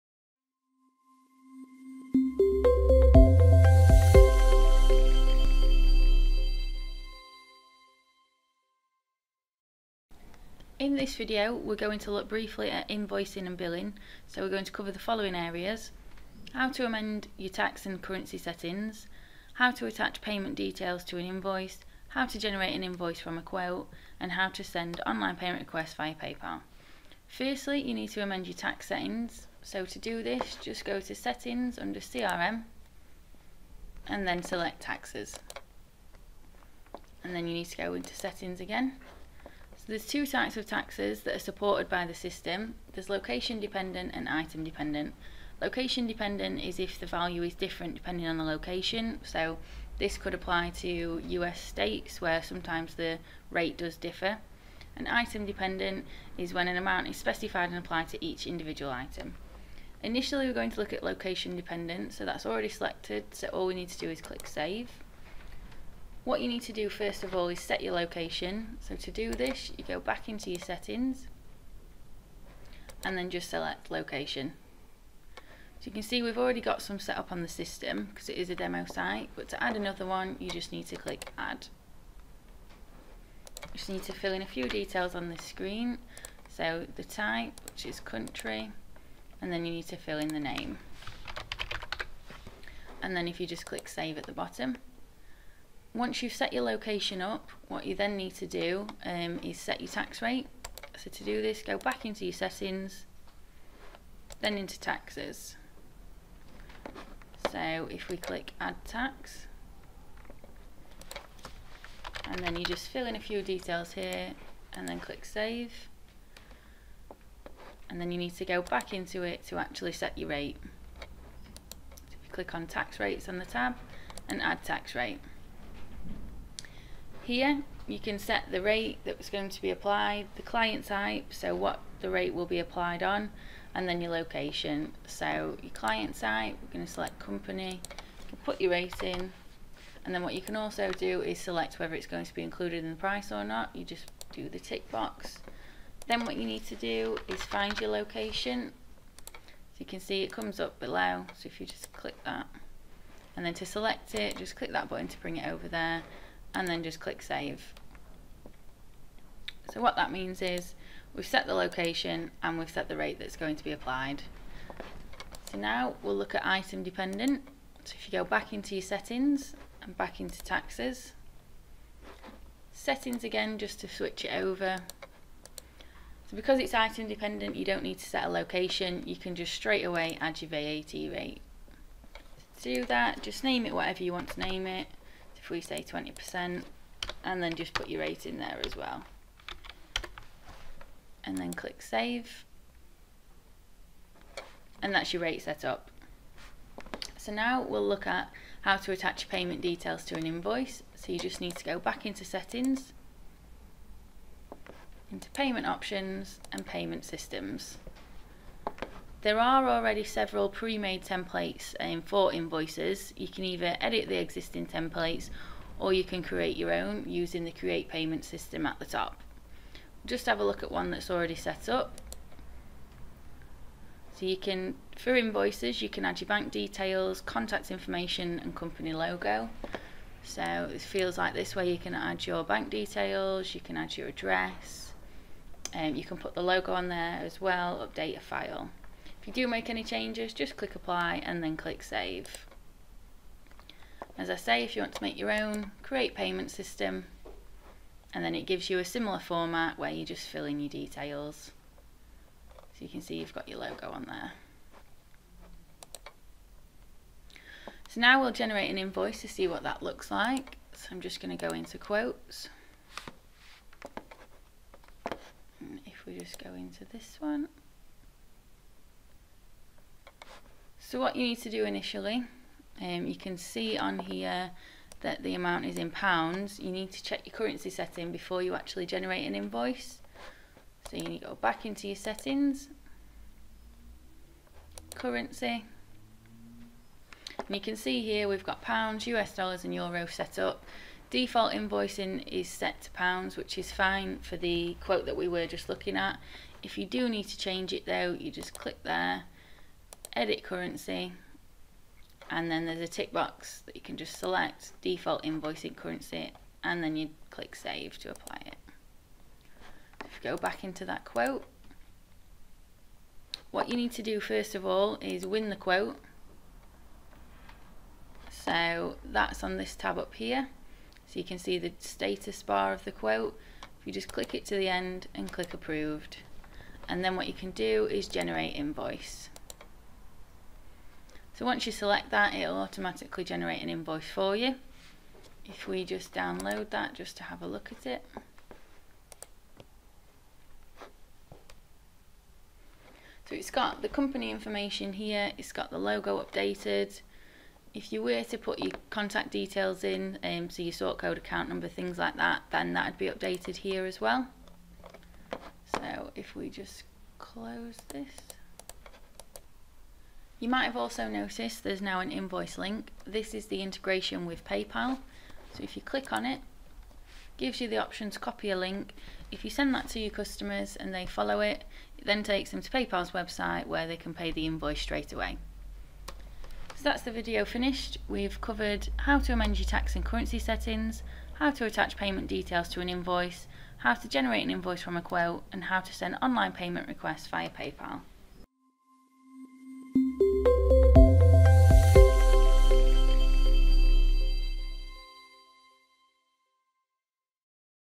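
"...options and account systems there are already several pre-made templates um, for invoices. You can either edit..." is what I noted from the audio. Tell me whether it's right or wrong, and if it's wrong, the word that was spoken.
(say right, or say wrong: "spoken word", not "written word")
wrong: "payment", not "account".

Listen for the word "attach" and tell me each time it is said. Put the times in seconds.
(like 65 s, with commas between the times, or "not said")
19 s, 198 s, 381 s.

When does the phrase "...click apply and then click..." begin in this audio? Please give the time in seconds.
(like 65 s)
240 s.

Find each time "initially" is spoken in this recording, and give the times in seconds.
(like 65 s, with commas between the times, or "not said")
60 s, 271 s.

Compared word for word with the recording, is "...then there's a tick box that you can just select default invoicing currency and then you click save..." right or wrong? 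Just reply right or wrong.
right.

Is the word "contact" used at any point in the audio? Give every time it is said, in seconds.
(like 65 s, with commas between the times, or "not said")
227 s, 348 s.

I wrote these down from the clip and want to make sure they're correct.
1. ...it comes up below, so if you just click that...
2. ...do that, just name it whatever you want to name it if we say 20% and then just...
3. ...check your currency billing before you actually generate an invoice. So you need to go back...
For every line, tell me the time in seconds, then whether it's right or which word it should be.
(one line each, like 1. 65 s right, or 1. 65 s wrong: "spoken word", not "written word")
1. 150 s right
2. 182 s right
3. 277 s wrong: "setting", not "billing".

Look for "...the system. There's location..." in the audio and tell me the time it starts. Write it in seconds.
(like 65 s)
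42 s.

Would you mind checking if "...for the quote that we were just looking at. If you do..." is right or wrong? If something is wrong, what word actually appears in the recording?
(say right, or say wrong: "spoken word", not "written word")
right.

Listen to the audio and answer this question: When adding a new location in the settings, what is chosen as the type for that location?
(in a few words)
Country.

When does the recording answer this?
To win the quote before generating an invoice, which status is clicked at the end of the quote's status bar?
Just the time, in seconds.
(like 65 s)
325 s.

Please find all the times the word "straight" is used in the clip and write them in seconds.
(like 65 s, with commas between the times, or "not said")
179 s, 374 s.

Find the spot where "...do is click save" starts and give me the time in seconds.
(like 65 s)
63 s.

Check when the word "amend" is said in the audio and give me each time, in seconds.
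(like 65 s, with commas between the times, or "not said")
16 s, 28 s, 379 s.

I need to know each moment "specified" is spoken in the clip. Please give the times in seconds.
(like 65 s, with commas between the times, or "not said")
57 s.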